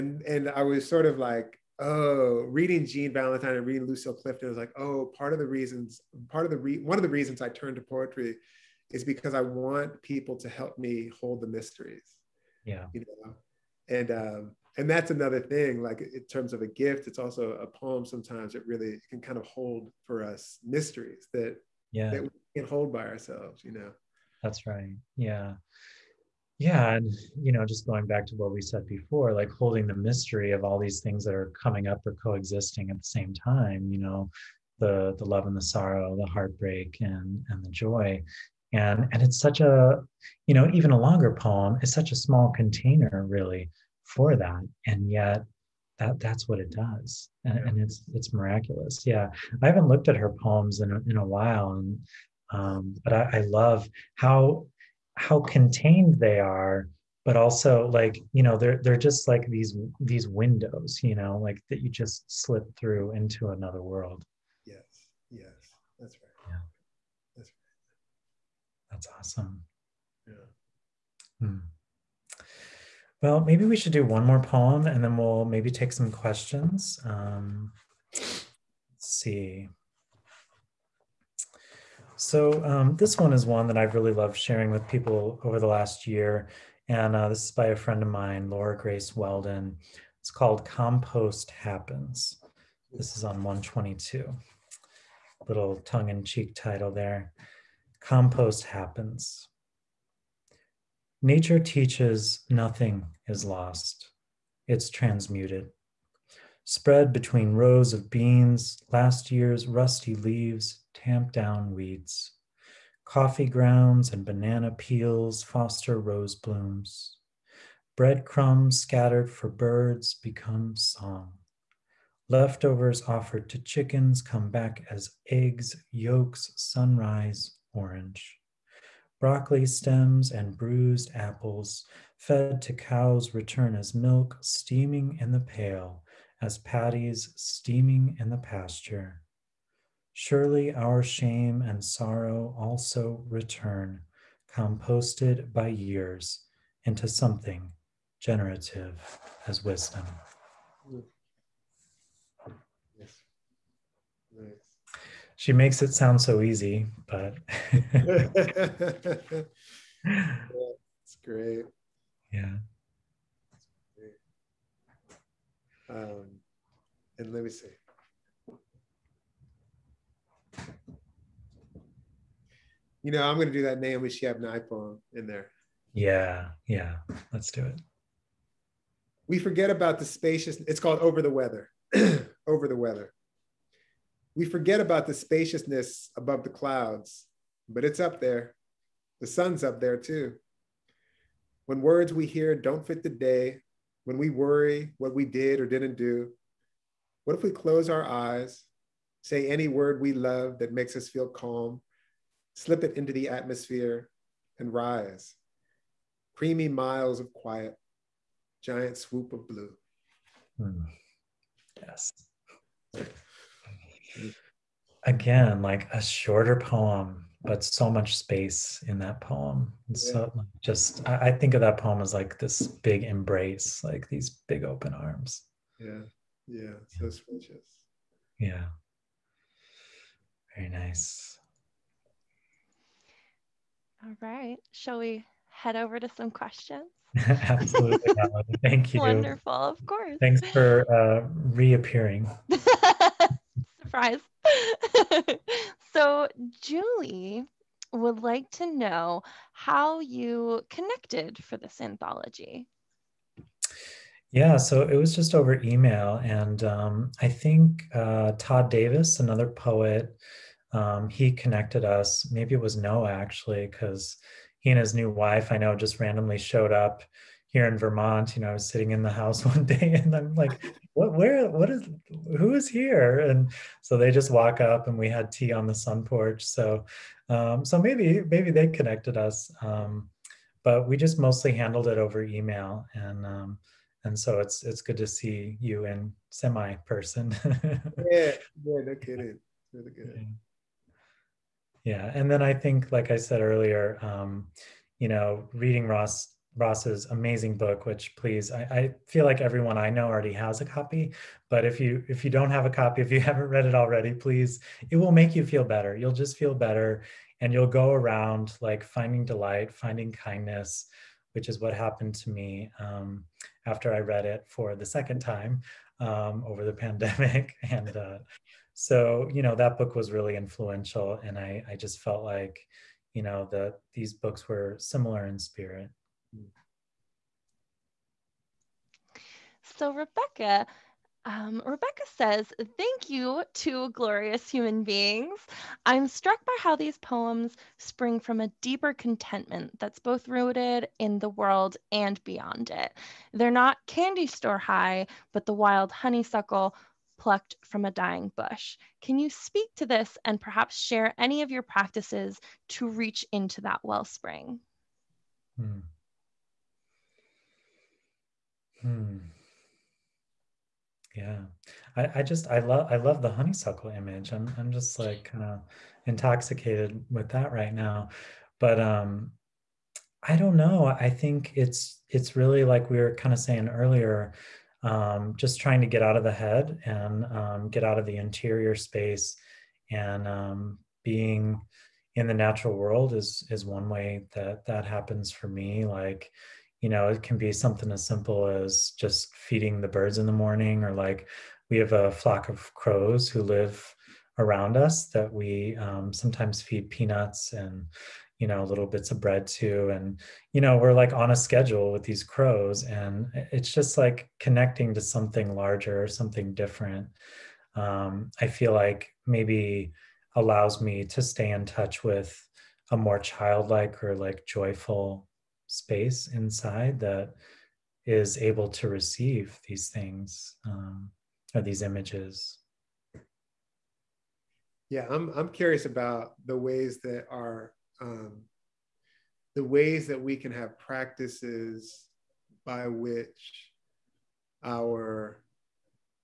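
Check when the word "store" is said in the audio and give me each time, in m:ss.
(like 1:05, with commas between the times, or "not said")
5:44.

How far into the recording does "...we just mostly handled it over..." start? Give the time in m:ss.
4:40.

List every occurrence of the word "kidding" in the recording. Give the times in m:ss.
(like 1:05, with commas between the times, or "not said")
4:48.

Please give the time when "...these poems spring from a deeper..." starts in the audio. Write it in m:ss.
5:36.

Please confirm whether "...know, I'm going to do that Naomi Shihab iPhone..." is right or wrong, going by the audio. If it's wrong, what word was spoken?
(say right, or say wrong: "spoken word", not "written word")
right.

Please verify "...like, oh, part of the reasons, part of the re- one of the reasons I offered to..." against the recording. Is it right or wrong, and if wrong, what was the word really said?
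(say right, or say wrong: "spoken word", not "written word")
wrong: "turned", not "offered".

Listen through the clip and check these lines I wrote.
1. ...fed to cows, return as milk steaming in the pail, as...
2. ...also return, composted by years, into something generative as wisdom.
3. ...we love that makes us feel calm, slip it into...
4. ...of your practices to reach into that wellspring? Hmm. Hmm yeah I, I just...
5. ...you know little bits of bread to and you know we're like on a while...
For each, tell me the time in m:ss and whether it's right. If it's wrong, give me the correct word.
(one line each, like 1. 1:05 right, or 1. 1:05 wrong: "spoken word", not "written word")
1. 2:12 right
2. 2:22 right
3. 3:20 right
4. 5:51 right
5. 6:38 wrong: "schedule", not "while".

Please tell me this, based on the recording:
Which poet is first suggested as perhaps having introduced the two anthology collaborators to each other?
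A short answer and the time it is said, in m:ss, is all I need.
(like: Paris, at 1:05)
Todd Davis, at 4:18.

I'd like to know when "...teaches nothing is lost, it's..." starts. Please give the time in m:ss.
1:41.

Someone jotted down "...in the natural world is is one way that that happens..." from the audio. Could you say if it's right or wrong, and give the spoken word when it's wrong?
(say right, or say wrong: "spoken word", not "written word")
right.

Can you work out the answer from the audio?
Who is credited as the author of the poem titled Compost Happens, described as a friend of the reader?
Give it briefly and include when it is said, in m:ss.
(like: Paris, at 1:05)
Laura Grace Weldon, at 1:28.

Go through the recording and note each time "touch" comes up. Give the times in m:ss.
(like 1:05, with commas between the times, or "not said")
6:51.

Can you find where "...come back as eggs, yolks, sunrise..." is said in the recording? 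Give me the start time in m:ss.
2:04.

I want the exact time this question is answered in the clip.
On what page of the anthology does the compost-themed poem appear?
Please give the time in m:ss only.
1:33.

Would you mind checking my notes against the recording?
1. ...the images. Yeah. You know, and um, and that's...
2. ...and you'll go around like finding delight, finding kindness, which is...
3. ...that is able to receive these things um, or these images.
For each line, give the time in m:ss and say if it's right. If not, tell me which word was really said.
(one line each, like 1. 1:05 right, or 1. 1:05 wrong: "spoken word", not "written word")
1. 0:11 wrong: "mysteries", not "images"
2. 5:07 right
3. 6:56 right.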